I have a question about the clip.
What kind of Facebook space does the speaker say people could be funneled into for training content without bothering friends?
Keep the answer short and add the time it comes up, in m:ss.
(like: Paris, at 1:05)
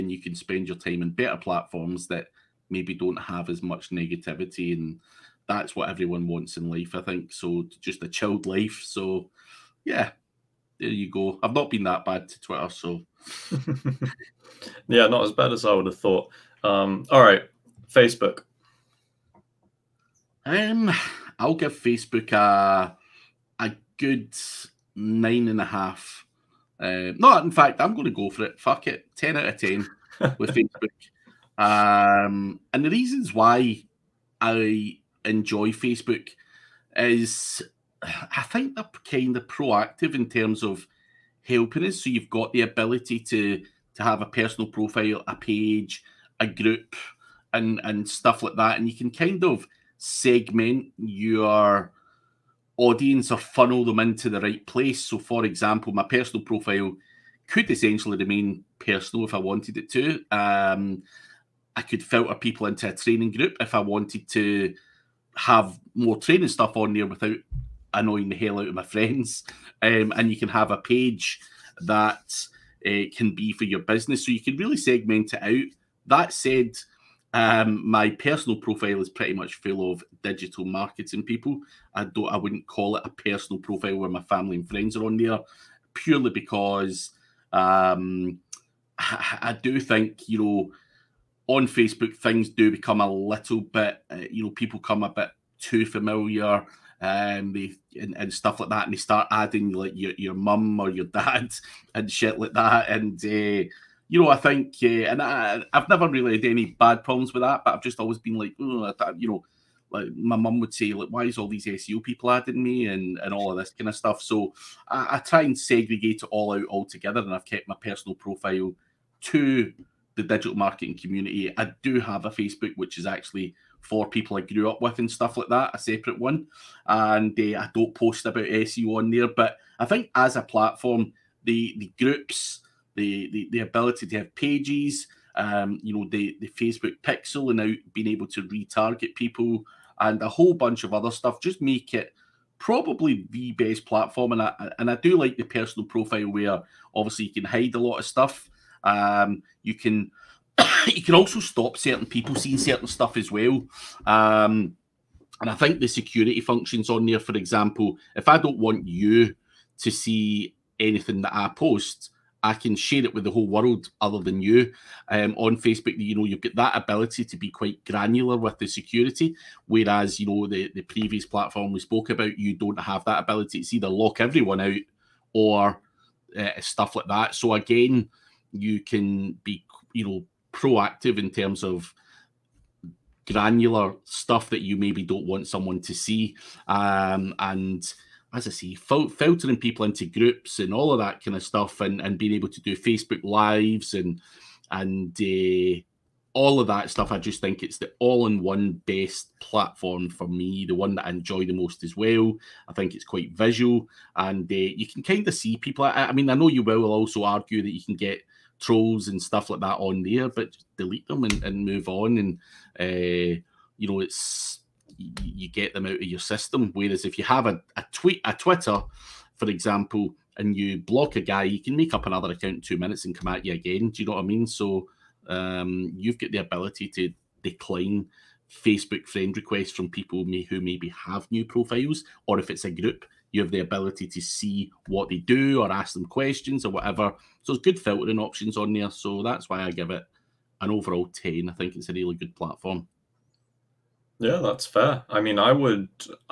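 A training group, at 1:02.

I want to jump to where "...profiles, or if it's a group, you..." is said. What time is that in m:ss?
3:51.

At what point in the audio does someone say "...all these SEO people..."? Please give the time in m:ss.
1:51.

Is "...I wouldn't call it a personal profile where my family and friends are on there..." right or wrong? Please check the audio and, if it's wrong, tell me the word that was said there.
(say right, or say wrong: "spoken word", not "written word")
right.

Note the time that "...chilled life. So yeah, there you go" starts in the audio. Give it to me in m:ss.
0:08.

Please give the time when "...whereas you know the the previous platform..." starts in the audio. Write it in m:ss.
2:49.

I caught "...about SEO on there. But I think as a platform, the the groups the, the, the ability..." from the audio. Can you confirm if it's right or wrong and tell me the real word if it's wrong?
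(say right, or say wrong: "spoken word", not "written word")
right.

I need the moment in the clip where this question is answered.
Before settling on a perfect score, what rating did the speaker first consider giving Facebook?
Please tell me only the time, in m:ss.
0:24.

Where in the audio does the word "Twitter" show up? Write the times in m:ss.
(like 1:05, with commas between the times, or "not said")
0:12, 3:38.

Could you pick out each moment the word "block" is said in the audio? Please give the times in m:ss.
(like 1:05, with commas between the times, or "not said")
3:40.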